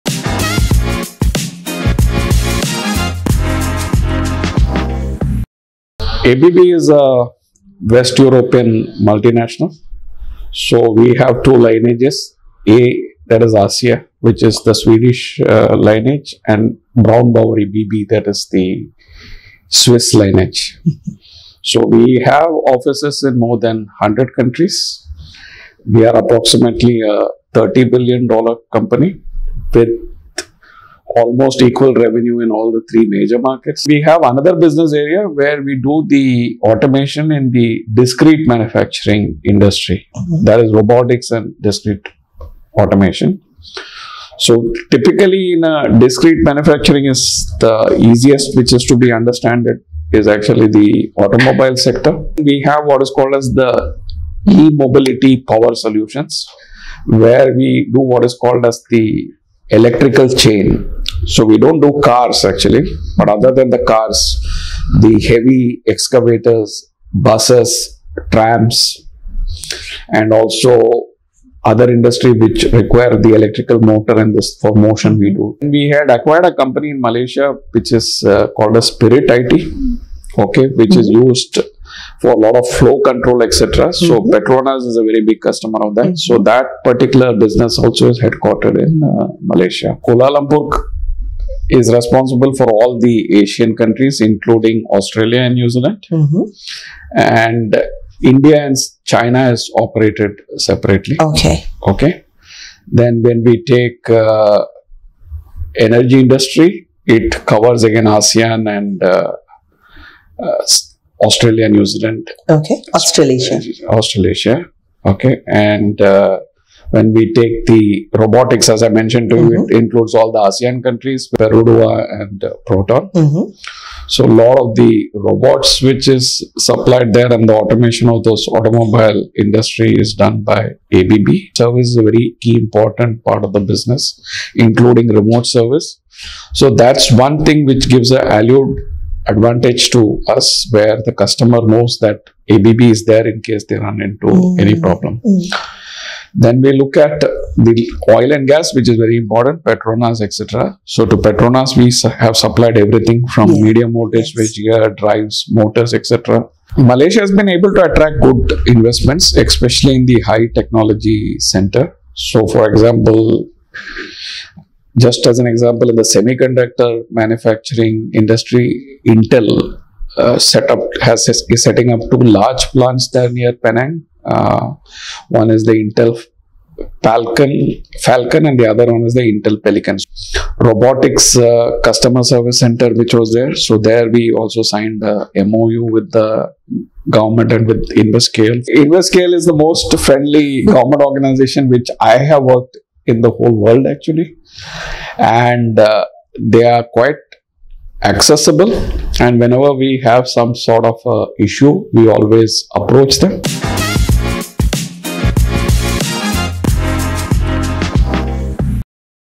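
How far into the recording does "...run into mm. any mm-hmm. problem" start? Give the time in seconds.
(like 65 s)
143 s.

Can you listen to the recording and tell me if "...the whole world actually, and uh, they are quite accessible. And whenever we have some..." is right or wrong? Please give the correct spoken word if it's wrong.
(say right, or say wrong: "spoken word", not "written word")
right.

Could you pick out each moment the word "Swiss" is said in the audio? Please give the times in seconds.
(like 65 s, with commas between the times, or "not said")
19 s.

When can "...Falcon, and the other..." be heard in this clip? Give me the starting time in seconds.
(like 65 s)
178 s.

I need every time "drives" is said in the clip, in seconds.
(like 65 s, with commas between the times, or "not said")
154 s.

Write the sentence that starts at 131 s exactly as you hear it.
Service is a very key important part of the business, including remote service.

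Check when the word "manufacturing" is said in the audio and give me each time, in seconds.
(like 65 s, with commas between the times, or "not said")
38 s, 46 s, 167 s.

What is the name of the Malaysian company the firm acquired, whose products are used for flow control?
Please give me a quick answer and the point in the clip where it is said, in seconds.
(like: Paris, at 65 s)
Spirit IT, at 78 s.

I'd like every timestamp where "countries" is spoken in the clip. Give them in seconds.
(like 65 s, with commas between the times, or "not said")
24 s, 93 s, 120 s.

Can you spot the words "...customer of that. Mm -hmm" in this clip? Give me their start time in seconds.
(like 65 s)
85 s.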